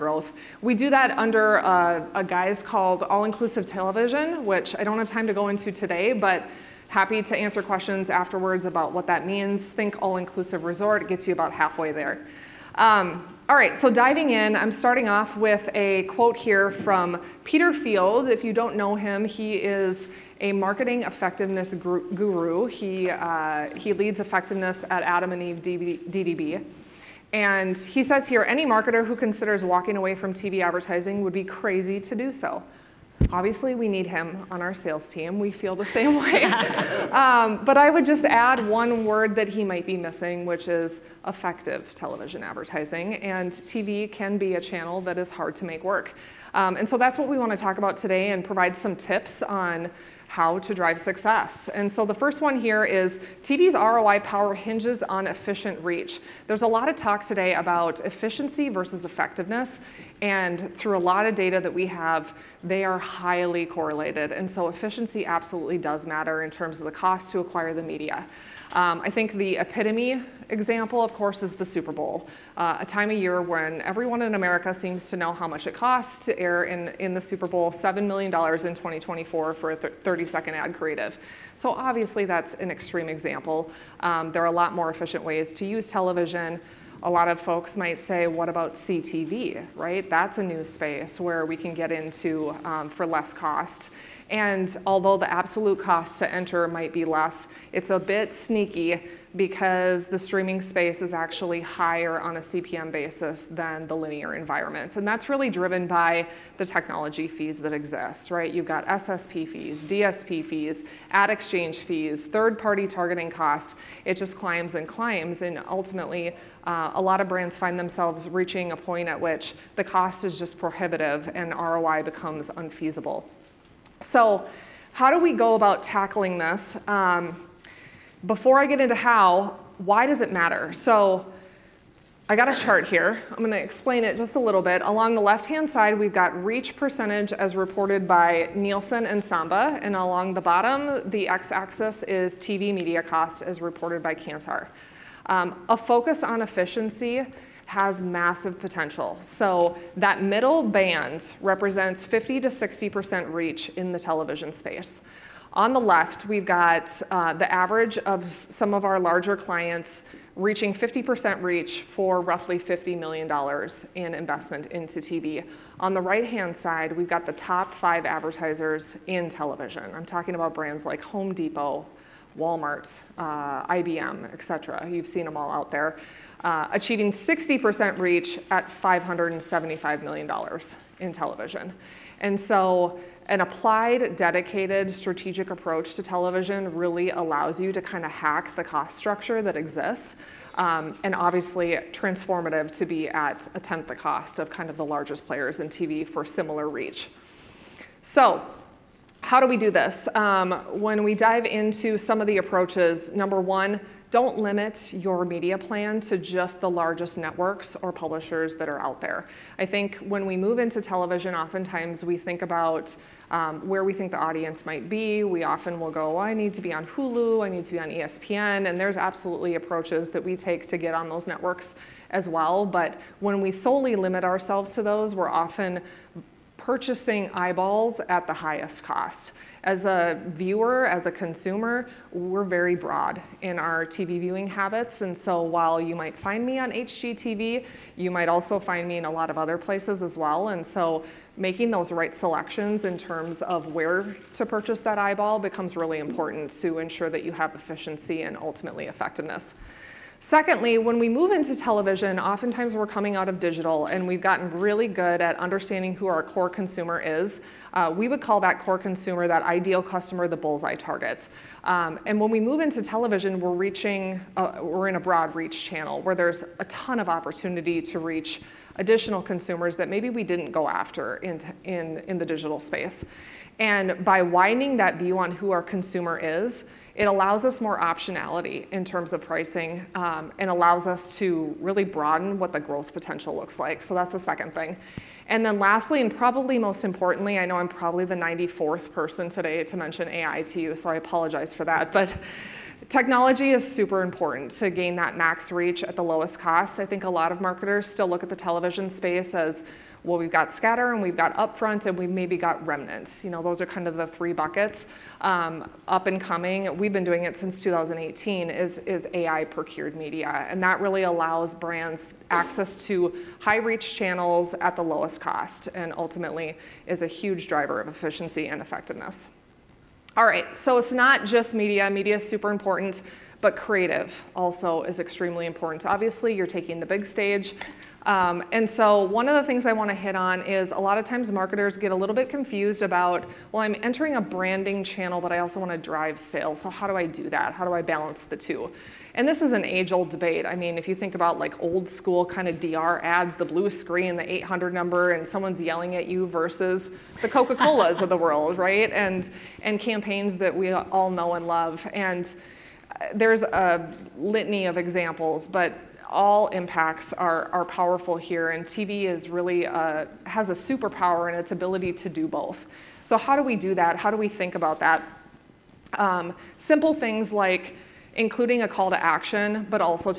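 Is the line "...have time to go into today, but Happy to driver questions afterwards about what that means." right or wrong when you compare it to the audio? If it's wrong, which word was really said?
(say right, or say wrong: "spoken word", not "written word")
wrong: "answer", not "driver".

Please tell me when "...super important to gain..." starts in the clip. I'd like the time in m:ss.
4:53.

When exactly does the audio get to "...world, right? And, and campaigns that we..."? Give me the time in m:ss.
5:48.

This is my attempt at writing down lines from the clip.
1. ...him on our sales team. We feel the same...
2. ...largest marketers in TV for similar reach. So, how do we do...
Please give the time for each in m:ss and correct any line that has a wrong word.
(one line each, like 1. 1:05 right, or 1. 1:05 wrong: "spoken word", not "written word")
1. 0:34 right
2. 3:14 wrong: "players", not "marketers".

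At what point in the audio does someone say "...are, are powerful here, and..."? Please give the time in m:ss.
5:57.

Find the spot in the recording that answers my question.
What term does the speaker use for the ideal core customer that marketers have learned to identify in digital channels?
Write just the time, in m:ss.
4:20.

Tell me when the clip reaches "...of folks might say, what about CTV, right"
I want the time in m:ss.
1:27.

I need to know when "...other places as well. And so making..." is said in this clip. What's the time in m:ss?
3:59.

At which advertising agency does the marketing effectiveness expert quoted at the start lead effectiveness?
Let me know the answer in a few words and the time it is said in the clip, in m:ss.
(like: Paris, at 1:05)
Adam and Eve DDB, at 0:25.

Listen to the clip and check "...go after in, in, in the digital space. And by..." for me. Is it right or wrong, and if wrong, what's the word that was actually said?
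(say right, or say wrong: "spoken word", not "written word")
right.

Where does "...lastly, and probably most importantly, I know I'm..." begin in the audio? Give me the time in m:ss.
4:45.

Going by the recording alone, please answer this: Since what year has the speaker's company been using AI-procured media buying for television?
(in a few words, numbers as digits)
2018.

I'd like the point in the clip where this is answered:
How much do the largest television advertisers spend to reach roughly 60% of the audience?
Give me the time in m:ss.
2:58.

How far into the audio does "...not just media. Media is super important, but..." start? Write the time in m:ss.
5:20.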